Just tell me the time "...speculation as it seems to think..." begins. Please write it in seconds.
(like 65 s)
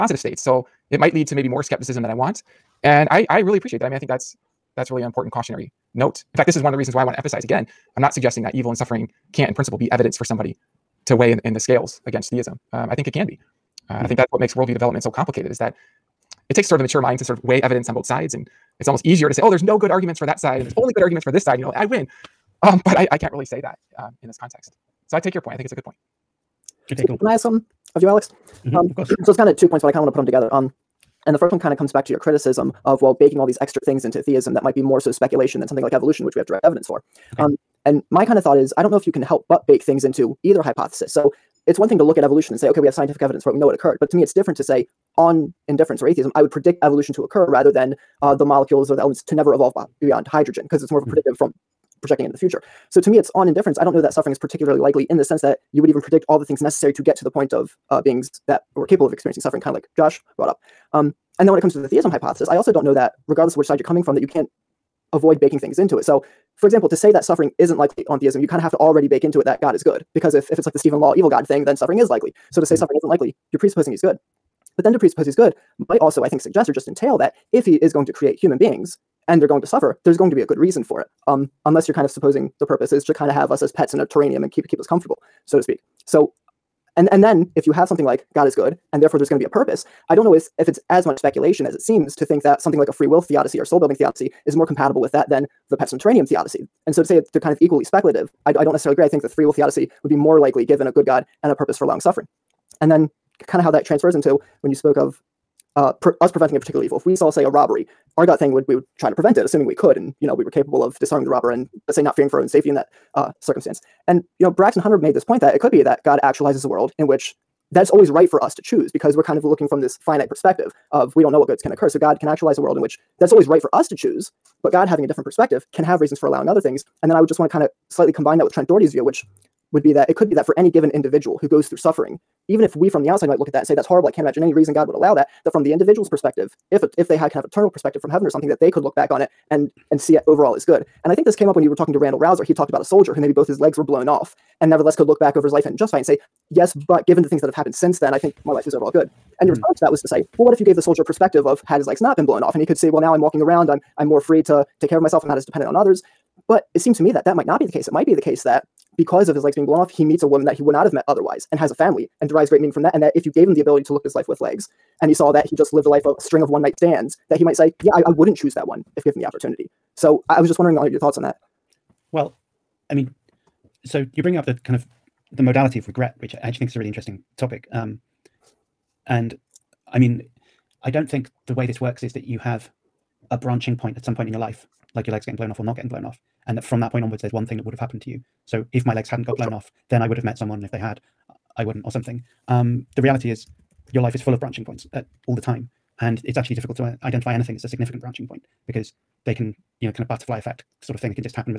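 91 s.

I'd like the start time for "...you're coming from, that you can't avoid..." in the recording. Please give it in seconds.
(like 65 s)
63 s.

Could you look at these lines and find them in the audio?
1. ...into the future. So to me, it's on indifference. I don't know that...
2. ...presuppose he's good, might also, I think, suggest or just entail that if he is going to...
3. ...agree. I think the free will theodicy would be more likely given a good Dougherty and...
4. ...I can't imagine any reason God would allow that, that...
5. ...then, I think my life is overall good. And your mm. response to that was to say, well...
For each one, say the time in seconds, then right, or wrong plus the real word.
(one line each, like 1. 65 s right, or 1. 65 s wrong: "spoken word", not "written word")
1. 52 s right
2. 74 s right
3. 98 s wrong: "God", not "Dougherty"
4. 134 s right
5. 147 s right.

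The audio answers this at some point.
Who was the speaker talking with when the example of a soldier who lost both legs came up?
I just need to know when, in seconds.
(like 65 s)
141 s.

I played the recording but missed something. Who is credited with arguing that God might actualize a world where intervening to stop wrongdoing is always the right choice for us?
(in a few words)
Braxton Hunter.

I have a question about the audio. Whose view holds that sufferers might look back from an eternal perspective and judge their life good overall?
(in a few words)
Trent Dougherty.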